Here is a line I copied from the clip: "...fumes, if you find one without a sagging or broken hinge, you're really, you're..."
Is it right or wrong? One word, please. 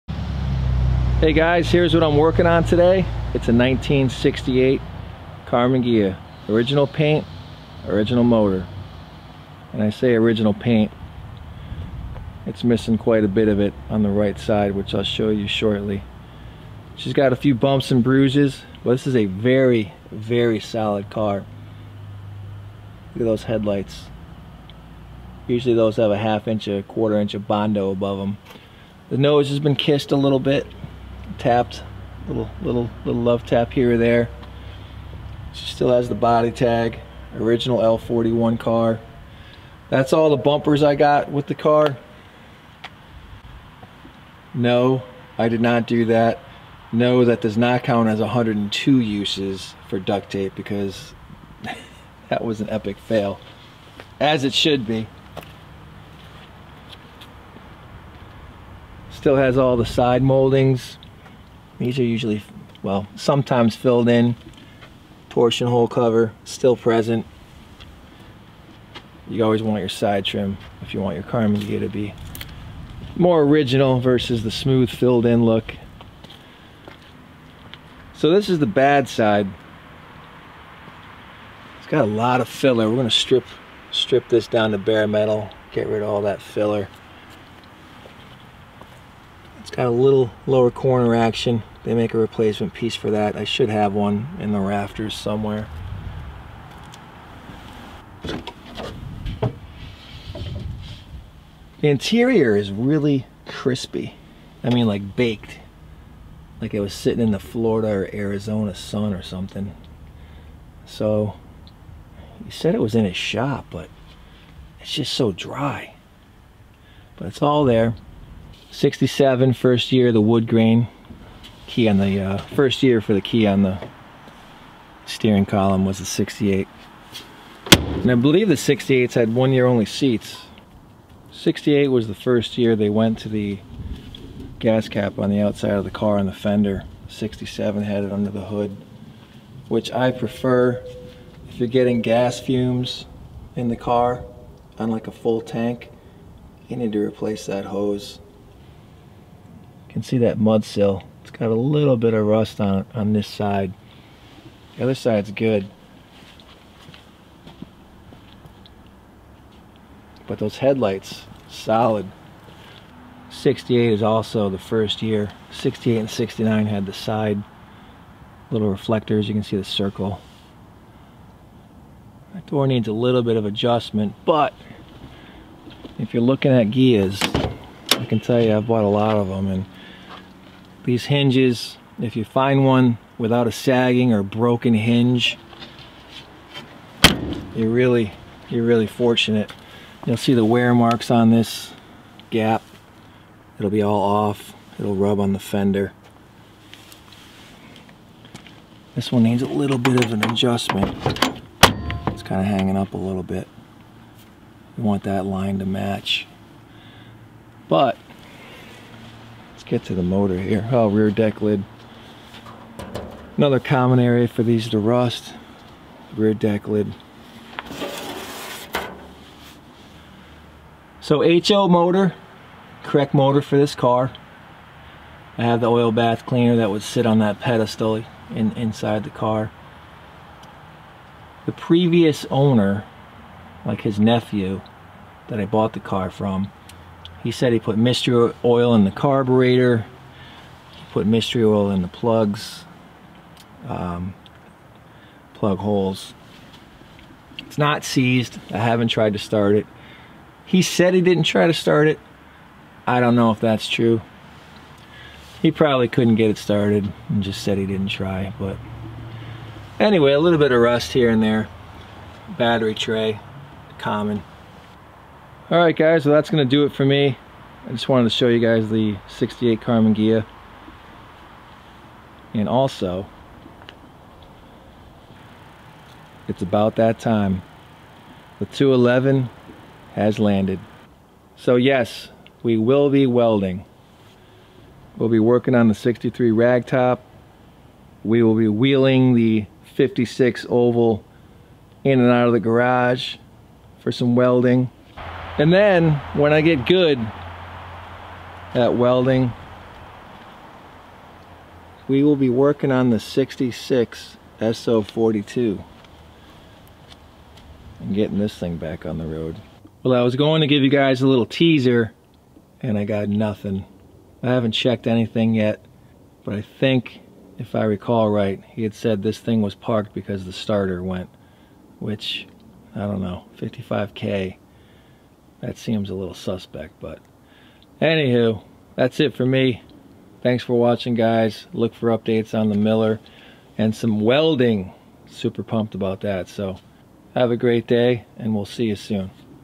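wrong.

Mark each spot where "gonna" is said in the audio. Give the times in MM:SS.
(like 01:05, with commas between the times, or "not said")
01:22, 04:26.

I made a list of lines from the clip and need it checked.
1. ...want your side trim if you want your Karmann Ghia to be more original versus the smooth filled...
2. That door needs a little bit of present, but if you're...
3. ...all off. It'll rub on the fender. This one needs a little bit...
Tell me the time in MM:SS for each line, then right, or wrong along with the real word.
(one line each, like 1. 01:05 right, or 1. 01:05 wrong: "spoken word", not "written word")
1. 01:09 right
2. 02:52 wrong: "adjustment", not "present"
3. 03:13 right.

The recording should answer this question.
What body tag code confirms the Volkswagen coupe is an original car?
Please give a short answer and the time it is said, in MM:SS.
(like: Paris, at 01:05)
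L41, at 00:37.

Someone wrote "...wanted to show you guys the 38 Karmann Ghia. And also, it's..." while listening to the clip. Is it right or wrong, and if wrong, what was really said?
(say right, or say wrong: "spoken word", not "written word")
wrong: "68", not "38".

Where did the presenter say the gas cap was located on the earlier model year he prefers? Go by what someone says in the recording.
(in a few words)
under the hood.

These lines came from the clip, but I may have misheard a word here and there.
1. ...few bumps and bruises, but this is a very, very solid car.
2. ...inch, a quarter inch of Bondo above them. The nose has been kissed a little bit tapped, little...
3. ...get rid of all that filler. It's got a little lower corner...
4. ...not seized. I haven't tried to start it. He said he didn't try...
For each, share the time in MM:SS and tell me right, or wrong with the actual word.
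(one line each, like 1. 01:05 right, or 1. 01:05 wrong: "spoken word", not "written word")
1. 00:17 right
2. 00:26 right
3. 01:25 right
4. 04:07 right.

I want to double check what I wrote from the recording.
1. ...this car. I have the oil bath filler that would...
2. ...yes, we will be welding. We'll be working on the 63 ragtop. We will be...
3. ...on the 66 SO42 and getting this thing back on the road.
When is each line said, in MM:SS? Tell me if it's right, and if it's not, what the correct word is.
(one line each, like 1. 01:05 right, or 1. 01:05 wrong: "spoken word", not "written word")
1. 03:43 wrong: "cleaner", not "filler"
2. 04:41 right
3. 05:02 right.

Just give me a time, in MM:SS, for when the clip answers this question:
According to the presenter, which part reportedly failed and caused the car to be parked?
05:20.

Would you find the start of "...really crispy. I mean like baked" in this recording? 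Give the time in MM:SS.
01:42.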